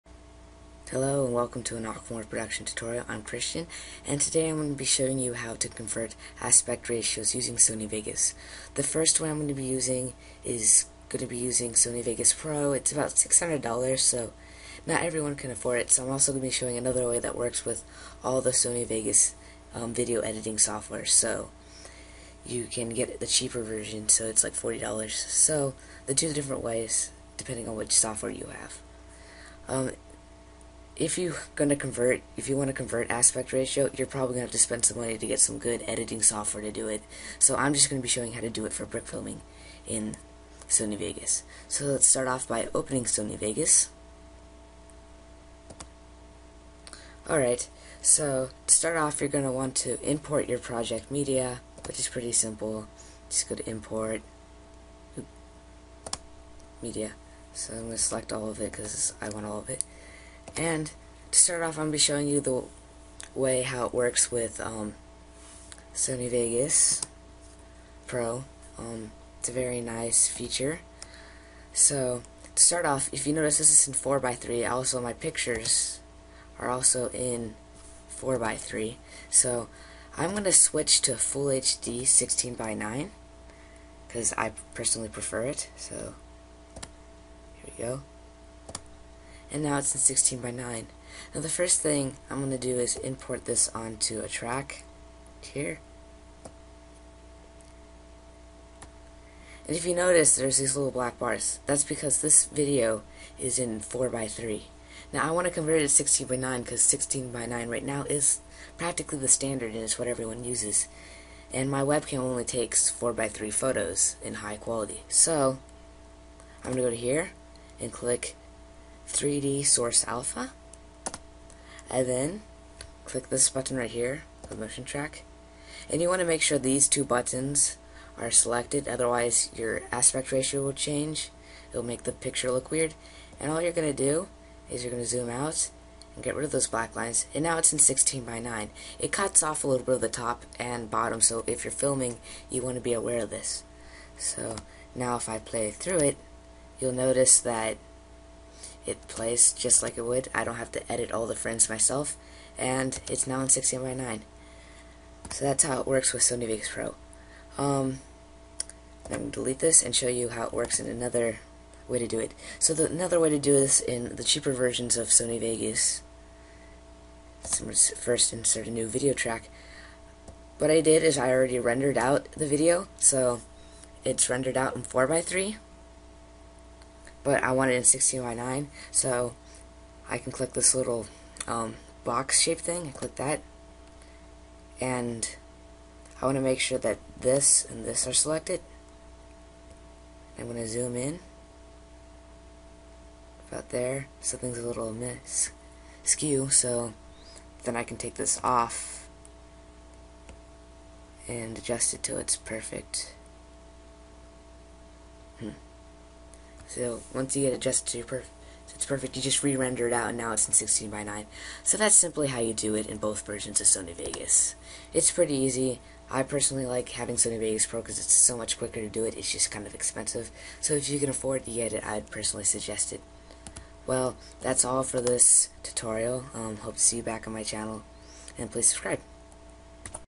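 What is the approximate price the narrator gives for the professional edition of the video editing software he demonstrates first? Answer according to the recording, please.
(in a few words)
$600.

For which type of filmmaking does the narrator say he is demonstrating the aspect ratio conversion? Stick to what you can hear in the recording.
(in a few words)
Brick filming.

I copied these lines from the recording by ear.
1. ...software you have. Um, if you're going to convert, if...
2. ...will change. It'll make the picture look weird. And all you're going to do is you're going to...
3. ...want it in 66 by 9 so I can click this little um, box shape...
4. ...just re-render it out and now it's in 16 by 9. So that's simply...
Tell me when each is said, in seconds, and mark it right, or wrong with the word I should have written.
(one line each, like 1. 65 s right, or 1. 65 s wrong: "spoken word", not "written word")
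1. 27 s right
2. 130 s right
3. 177 s wrong: "16", not "66"
4. 209 s right.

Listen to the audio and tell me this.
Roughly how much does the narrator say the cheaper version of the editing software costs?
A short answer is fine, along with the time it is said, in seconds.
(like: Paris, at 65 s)
$40, at 24 s.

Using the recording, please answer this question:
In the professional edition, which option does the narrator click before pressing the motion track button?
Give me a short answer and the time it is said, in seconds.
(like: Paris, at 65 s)
3D Source Alpha, at 119 s.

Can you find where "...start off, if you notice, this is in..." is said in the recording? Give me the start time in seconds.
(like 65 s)
72 s.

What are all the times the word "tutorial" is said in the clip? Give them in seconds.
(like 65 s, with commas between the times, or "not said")
2 s, 225 s.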